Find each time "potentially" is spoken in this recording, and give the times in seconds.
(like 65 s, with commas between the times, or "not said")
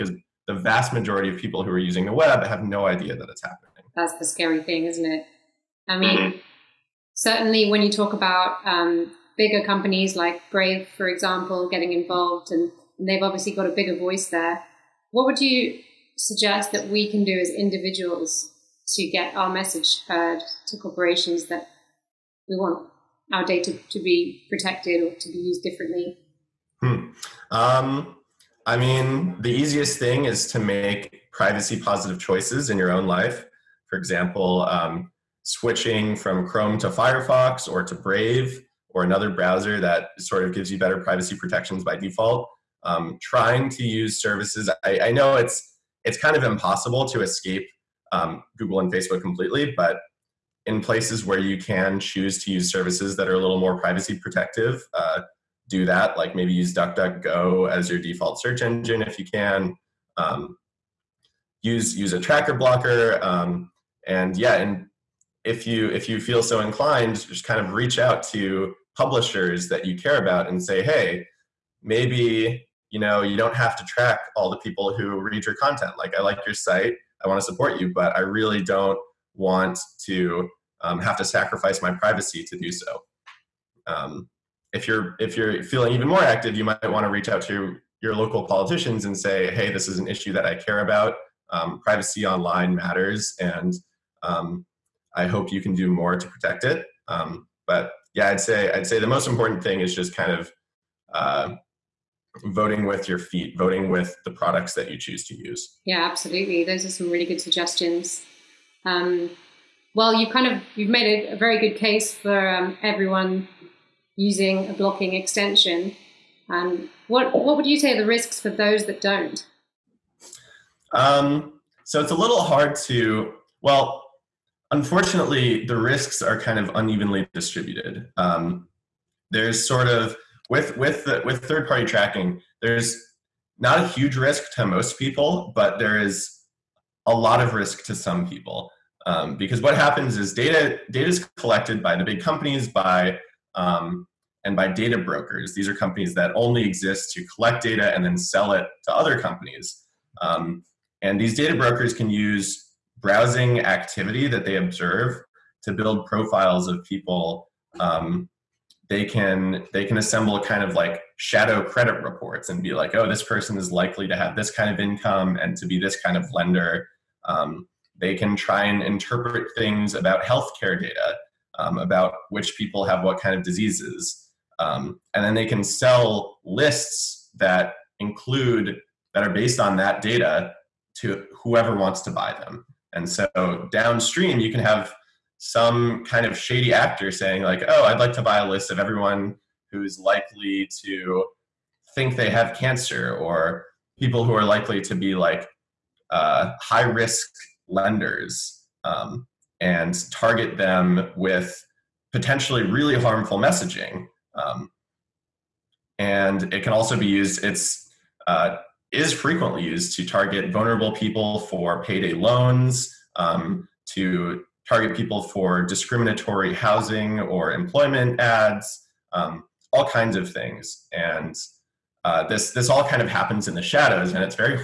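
202 s.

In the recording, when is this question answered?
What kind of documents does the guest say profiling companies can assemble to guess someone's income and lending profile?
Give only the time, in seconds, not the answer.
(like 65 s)
161 s.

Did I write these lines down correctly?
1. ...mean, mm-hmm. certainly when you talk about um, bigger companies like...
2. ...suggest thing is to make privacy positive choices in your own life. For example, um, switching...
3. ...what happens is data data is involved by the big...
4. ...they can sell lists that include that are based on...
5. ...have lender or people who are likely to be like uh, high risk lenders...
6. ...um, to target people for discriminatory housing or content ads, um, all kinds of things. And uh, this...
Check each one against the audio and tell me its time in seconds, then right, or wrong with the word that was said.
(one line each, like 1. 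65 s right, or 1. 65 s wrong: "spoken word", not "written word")
1. 5 s right
2. 29 s wrong: "easiest", not "suggest"
3. 139 s wrong: "collected", not "involved"
4. 175 s right
5. 192 s wrong: "cancer", not "lender"
6. 213 s wrong: "employment", not "content".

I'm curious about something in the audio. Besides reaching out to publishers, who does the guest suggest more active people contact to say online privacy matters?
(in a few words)
Local politicians.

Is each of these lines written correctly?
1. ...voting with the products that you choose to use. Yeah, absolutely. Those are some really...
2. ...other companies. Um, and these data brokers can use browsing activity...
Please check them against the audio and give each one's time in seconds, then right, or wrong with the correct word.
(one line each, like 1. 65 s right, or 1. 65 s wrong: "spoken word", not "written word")
1. 103 s right
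2. 148 s right.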